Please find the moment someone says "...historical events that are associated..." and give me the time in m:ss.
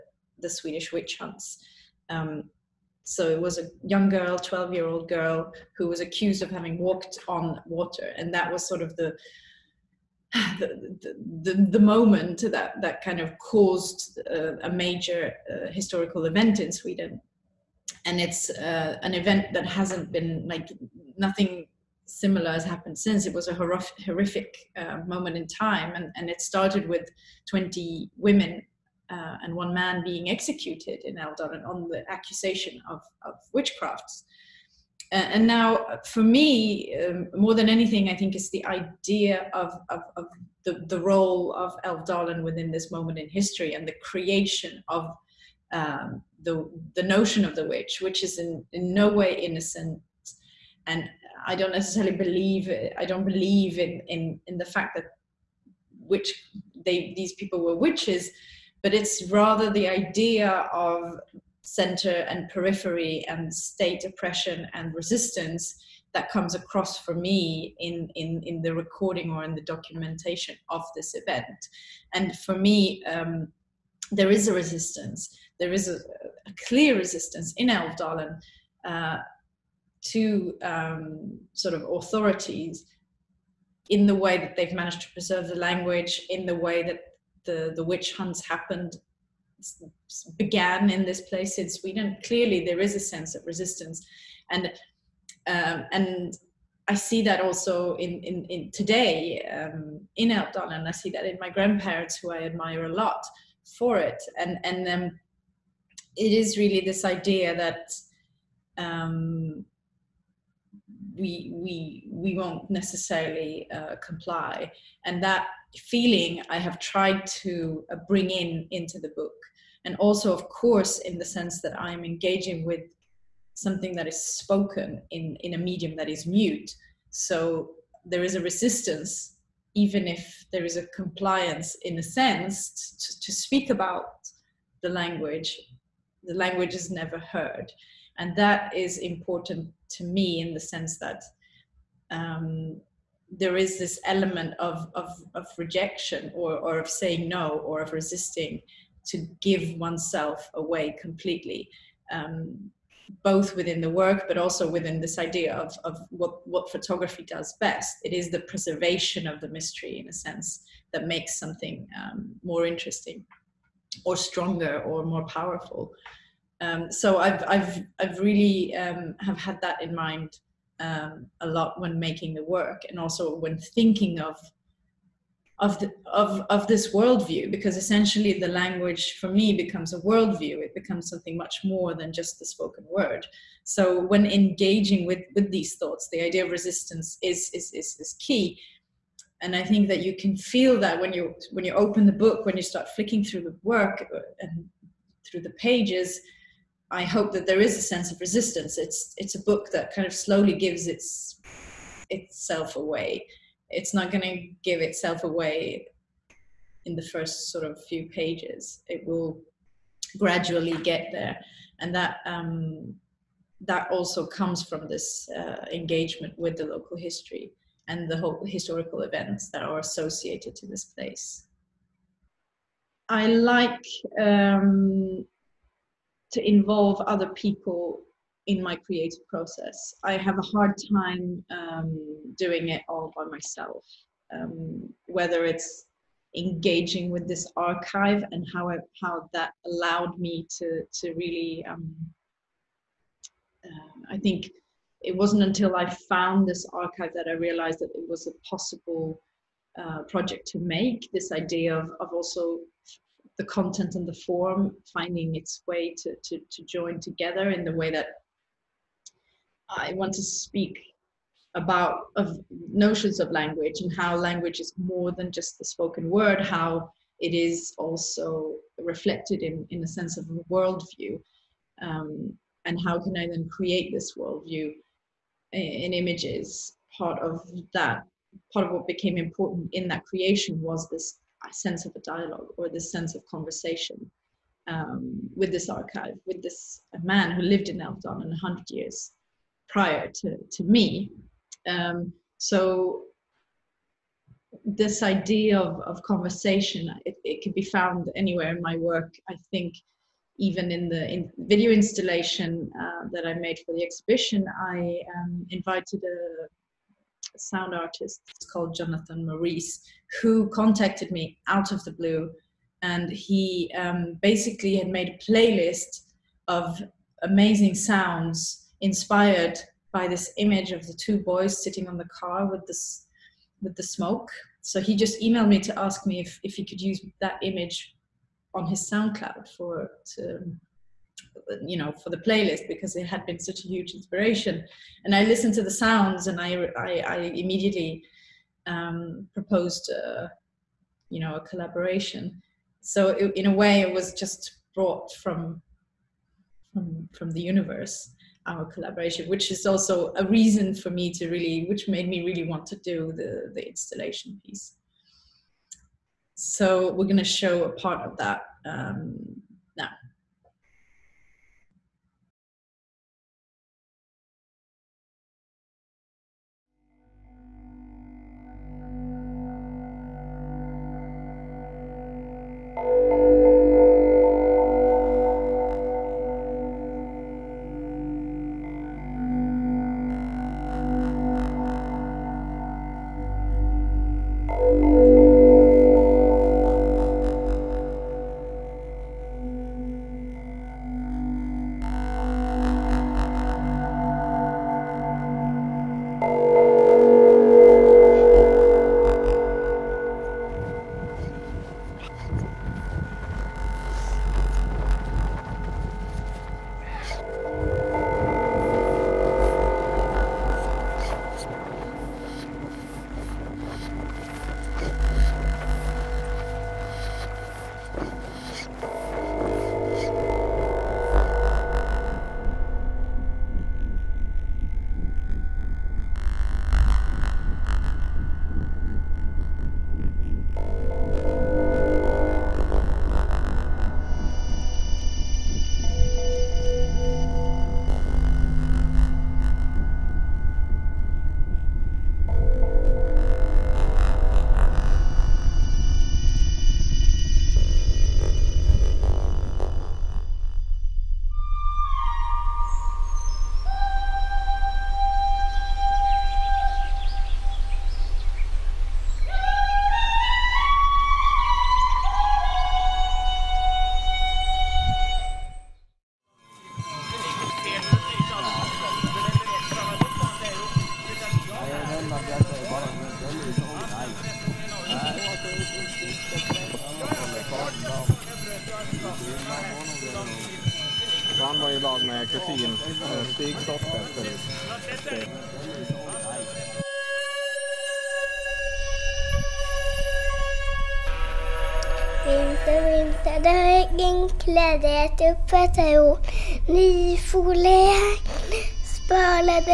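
3:38.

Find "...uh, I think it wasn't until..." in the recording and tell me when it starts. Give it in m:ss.
4:03.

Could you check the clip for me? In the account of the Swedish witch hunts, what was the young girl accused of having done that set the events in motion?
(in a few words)
walked on water.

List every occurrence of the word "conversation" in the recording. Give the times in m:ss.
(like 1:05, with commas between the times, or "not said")
4:43, 4:56.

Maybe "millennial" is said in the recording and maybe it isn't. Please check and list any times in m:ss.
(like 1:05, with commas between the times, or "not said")
not said.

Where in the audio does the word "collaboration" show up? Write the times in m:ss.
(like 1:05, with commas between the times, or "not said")
5:41, 5:48.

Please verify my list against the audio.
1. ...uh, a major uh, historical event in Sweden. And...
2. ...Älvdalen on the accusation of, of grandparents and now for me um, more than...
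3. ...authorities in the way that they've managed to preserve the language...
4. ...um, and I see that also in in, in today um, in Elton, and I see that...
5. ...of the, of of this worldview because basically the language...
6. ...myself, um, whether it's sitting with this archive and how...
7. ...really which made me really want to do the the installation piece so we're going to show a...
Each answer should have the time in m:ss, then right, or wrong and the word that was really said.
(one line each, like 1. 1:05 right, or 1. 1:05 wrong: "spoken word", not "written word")
1. 0:14 right
2. 0:31 wrong: "witchcrafts", not "grandparents"
3. 1:21 right
4. 1:35 right
5. 2:55 wrong: "essentially", not "basically"
6. 3:53 wrong: "engaging", not "sitting"
7. 5:51 right.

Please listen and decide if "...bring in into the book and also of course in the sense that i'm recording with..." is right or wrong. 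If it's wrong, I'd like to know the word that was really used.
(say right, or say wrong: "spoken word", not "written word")
wrong: "engaging", not "recording".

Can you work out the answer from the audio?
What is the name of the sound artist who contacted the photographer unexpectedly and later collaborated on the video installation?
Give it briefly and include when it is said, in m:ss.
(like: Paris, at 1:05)
Jonathan Maurice, at 5:08.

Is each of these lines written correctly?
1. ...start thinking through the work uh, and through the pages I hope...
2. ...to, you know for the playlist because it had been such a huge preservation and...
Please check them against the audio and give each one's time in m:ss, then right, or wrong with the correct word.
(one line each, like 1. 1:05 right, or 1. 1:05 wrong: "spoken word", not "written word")
1. 3:12 wrong: "flicking", not "thinking"
2. 5:30 wrong: "inspiration", not "preservation".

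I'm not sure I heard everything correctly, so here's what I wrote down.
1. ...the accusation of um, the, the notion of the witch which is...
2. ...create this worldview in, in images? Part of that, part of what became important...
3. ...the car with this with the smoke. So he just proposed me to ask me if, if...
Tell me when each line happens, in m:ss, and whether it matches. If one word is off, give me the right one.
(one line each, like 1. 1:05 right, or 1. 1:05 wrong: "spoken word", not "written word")
1. 0:43 wrong: "creation", not "accusation"
2. 4:33 right
3. 5:21 wrong: "emailed", not "proposed".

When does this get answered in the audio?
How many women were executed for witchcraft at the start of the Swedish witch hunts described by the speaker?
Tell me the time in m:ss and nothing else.
0:27.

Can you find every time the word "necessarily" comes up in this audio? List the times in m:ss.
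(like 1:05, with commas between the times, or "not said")
0:51, 1:52.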